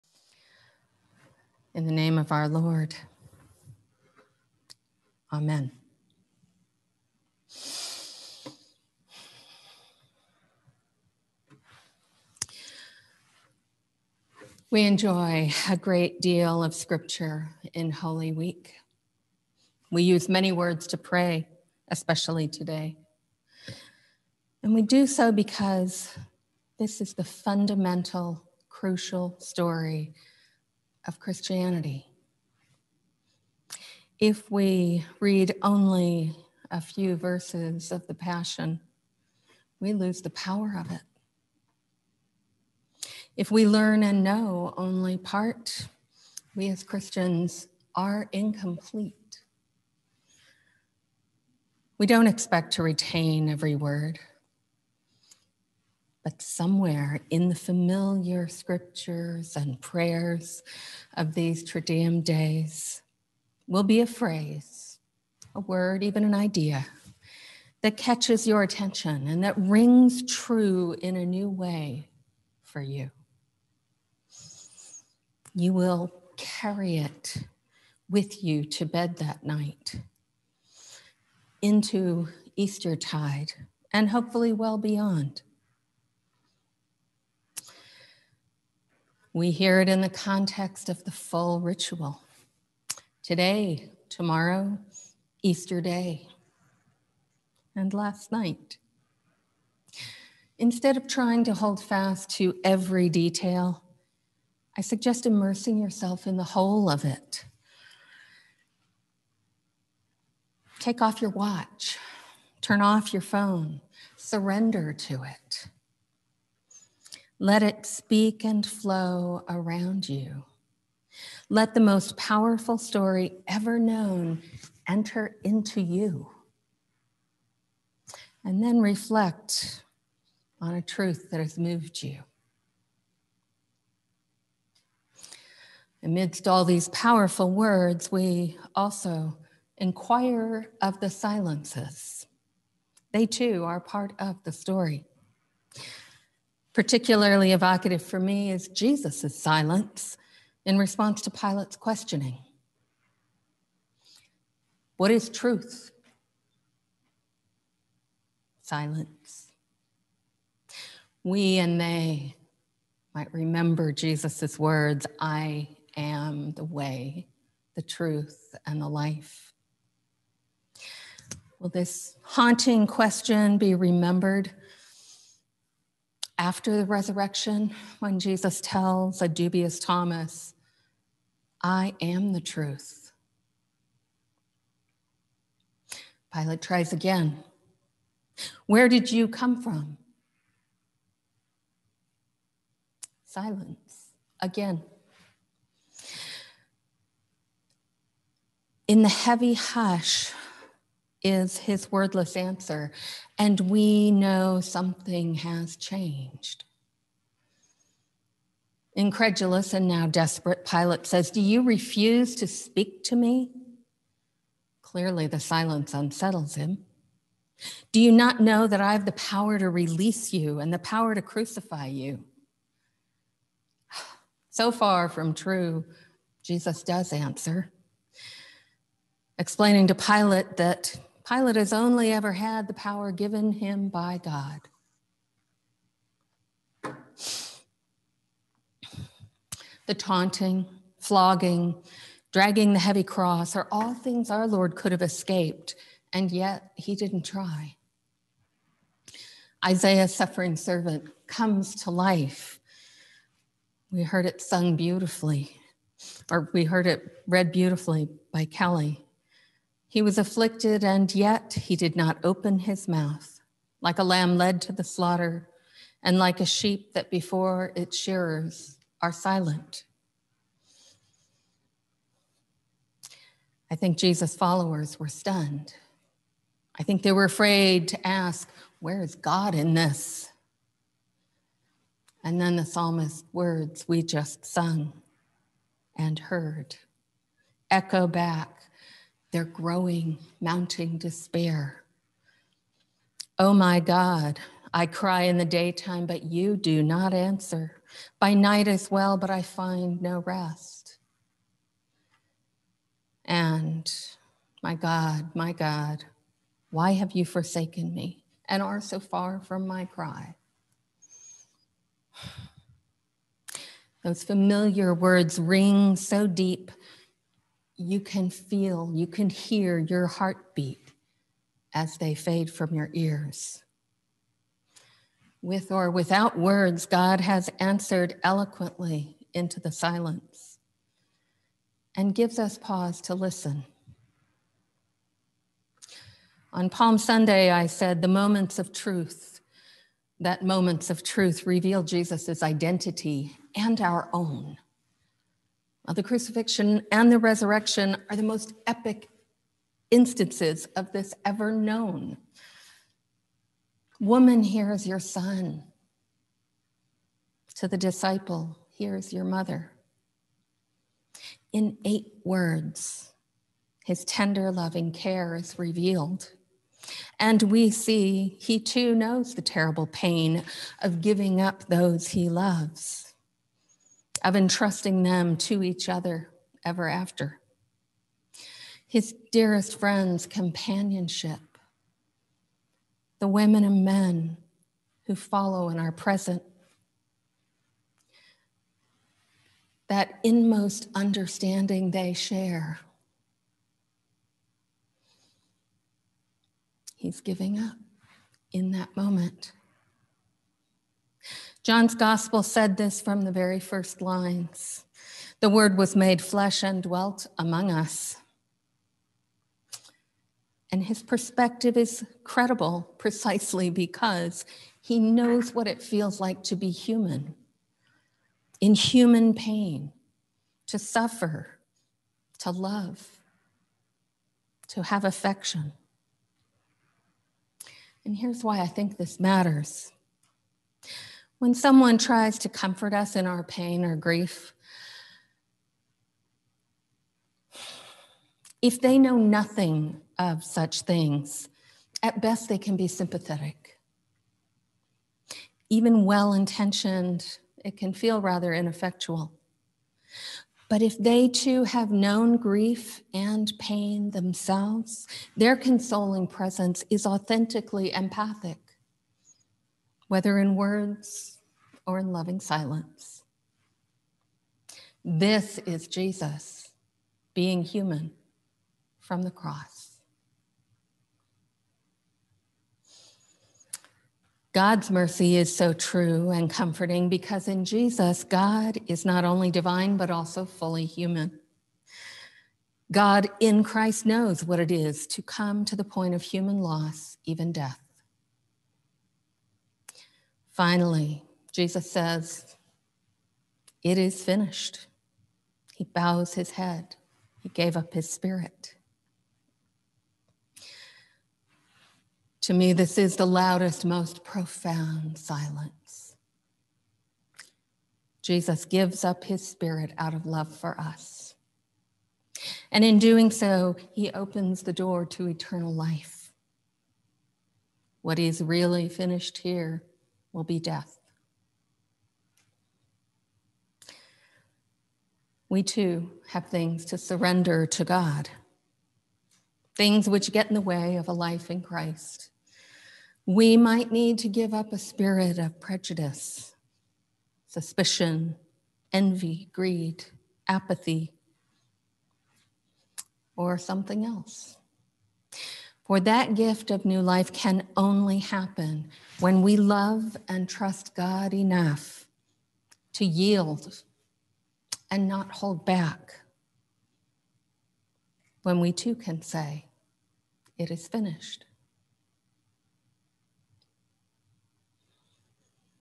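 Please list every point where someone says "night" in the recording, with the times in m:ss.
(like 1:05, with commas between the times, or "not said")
1:19, 1:38, 4:58.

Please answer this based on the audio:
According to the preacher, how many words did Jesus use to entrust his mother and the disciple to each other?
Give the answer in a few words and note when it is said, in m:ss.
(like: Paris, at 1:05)
8, at 6:01.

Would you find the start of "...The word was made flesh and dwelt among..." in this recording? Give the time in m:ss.
6:45.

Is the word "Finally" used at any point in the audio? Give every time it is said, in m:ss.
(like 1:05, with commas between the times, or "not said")
8:10.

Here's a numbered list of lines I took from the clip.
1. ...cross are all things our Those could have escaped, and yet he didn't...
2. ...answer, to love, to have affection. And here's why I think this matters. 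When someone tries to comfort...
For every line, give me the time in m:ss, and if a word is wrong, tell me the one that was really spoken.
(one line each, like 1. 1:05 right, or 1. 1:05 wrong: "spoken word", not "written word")
1. 4:03 wrong: "Lord", not "Those"
2. 7:00 wrong: "suffer", not "answer".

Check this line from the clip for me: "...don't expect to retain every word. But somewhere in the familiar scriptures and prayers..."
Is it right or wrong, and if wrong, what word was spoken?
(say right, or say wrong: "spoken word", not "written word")
right.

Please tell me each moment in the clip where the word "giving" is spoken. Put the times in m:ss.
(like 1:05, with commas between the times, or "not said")
6:11, 6:37.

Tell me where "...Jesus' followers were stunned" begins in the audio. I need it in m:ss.
4:33.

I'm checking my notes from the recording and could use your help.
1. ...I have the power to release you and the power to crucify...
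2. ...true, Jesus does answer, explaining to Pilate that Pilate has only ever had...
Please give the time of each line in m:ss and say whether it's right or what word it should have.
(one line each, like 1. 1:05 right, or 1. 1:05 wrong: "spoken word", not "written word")
1. 3:38 right
2. 3:45 right.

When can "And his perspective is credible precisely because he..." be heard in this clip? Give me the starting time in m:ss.
6:50.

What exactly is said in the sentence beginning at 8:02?
God in Christ knows what it is to come to the point of human loss, even death.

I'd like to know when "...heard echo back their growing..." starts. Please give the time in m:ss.
4:46.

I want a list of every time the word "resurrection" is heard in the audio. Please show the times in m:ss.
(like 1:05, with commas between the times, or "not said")
2:56, 5:47.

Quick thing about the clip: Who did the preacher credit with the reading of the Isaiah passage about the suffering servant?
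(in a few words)
Kelly.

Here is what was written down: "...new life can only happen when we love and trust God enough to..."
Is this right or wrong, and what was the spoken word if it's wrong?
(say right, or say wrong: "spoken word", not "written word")
right.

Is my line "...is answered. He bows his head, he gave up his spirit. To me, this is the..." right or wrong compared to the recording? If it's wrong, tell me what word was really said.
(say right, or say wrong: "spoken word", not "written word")
wrong: "finished", not "answered".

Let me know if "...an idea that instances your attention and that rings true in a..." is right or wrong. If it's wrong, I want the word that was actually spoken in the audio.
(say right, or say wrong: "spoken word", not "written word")
wrong: "catches", not "instances".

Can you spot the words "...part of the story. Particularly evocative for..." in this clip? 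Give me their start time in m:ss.
2:23.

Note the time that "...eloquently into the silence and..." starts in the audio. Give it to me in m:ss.
5:28.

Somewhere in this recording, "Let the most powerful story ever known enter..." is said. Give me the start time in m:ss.
2:01.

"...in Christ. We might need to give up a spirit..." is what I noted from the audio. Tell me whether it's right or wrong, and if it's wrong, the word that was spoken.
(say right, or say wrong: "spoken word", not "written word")
right.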